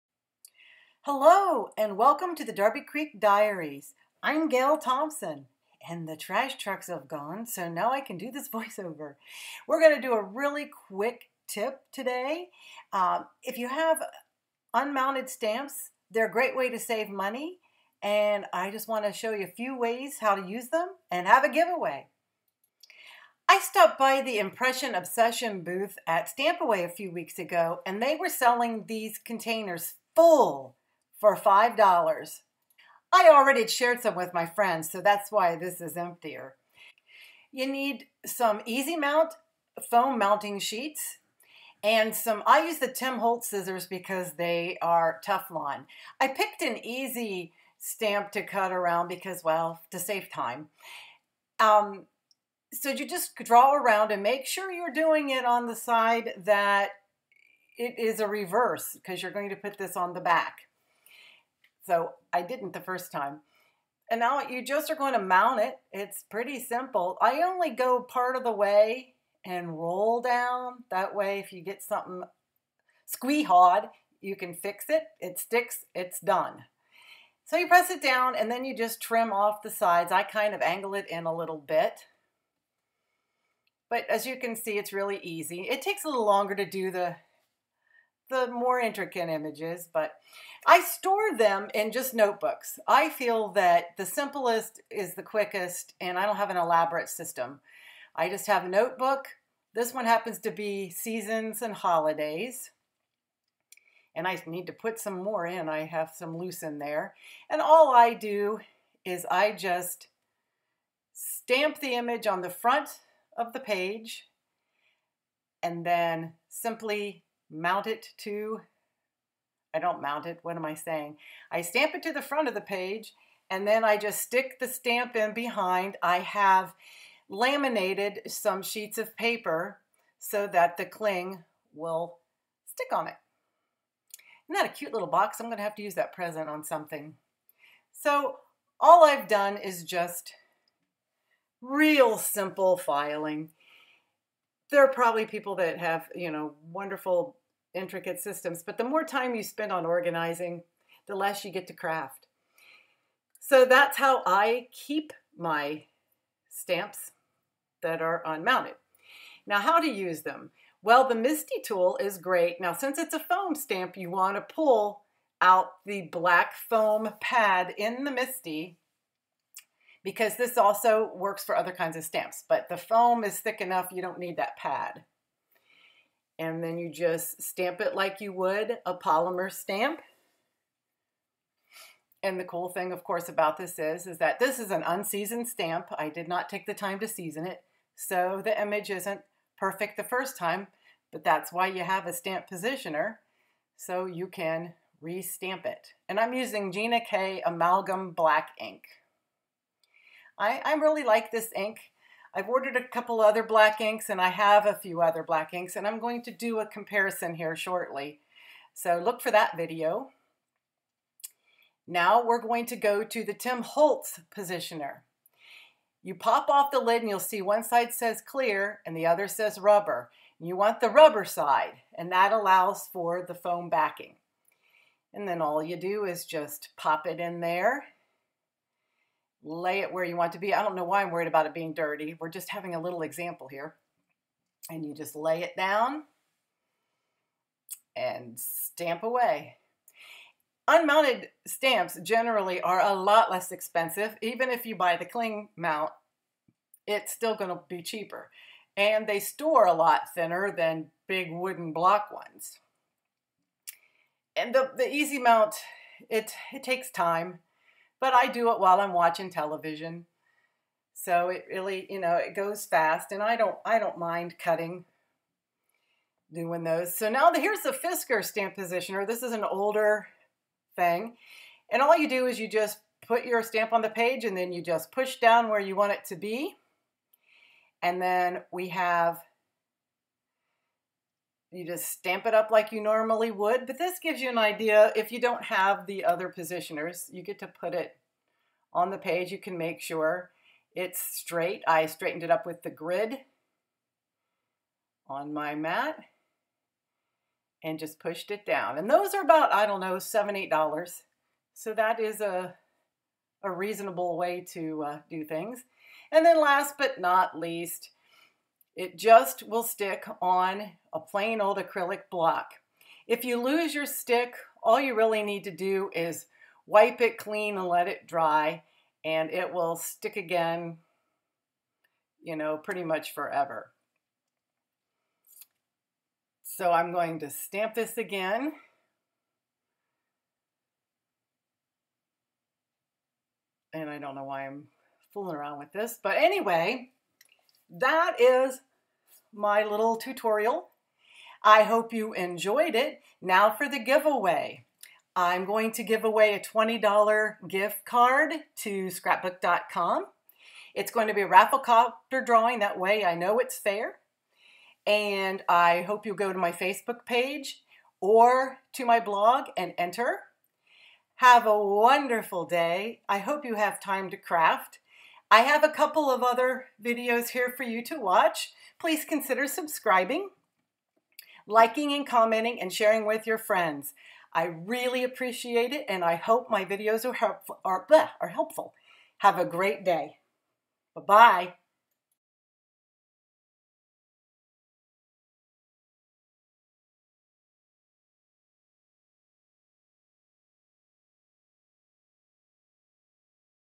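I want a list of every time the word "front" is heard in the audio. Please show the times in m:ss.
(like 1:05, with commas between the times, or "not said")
1:52, 2:02.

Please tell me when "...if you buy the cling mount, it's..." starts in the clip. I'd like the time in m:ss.
4:04.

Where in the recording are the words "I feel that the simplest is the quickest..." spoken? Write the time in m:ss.
1:32.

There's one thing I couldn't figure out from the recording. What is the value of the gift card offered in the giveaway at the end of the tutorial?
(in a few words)
$20.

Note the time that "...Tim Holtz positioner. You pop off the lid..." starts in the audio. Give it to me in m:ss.
3:33.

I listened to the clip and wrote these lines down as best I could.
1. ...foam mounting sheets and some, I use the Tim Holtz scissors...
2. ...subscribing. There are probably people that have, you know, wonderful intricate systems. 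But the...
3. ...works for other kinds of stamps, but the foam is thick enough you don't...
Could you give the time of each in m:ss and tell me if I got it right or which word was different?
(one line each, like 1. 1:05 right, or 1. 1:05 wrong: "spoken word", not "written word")
1. 0:39 right
2. 2:22 wrong: "filing", not "subscribing"
3. 2:51 right.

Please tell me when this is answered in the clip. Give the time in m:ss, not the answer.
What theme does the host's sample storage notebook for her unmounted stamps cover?
1:40.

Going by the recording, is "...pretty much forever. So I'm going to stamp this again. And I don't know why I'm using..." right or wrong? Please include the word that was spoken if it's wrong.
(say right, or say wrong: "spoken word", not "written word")
wrong: "fooling", not "using".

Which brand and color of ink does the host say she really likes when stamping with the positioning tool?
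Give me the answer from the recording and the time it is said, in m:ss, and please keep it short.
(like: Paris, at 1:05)
Gina K Amalgam Black, at 3:16.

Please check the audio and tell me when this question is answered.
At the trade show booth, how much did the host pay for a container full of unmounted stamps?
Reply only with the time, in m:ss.
0:31.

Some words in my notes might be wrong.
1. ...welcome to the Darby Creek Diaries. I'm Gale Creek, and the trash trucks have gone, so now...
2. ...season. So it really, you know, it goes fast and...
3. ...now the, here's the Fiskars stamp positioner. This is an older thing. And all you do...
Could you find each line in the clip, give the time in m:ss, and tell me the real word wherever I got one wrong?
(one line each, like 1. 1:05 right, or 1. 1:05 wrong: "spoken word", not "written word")
1. 0:01 wrong: "Thompson", not "Creek"
2. 4:19 wrong: "television", not "season"
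3. 4:27 right.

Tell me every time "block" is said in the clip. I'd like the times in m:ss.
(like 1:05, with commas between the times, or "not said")
4:11, 5:12.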